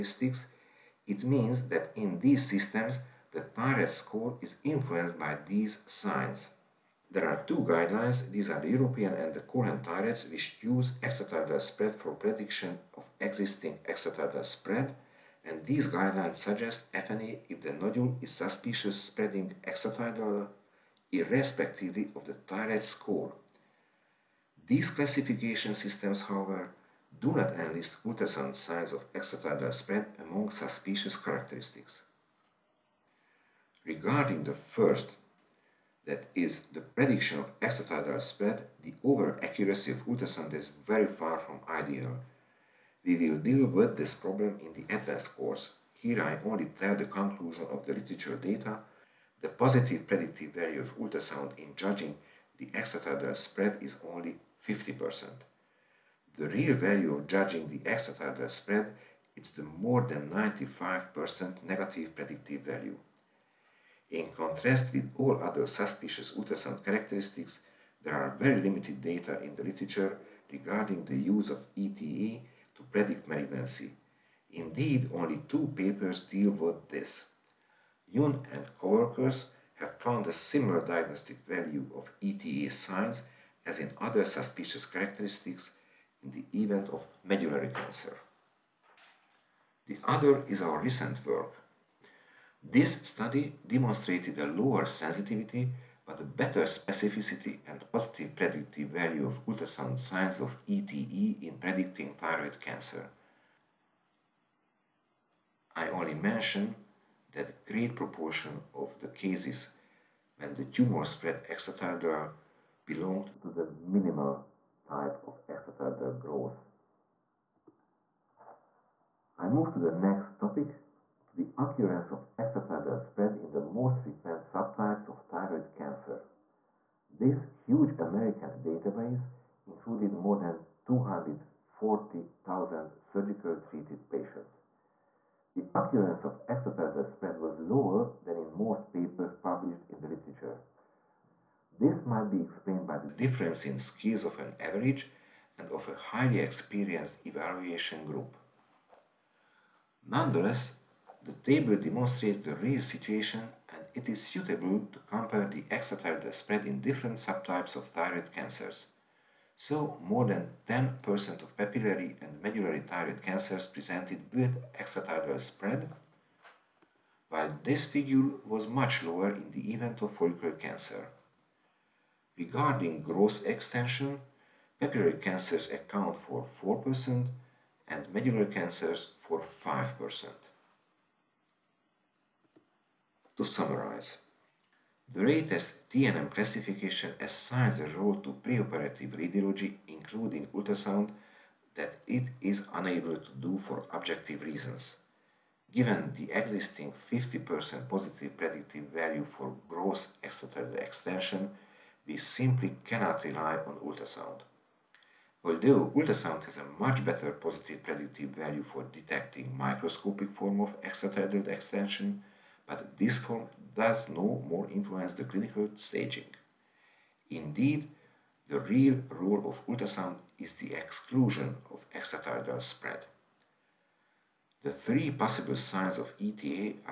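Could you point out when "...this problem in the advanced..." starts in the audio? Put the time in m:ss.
0:43.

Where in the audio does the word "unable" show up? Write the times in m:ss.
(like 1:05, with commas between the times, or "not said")
3:12.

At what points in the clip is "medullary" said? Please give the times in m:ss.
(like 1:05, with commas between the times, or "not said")
1:27, 2:42, 2:58.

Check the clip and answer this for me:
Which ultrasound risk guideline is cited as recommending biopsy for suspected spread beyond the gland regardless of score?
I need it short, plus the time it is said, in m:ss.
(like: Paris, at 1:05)
European, at 0:08.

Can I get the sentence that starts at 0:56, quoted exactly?
The real value of judging the extrathyroidal spread is the more than 95% negative predictive value.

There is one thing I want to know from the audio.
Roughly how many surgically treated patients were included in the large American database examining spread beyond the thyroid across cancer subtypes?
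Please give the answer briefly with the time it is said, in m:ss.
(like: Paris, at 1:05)
more than 240,000, at 2:10.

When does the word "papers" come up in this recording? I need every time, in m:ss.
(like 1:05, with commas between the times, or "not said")
1:15, 2:18.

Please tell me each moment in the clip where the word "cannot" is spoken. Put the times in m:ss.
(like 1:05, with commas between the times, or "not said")
3:22.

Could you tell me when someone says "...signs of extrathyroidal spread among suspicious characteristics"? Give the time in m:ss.
0:28.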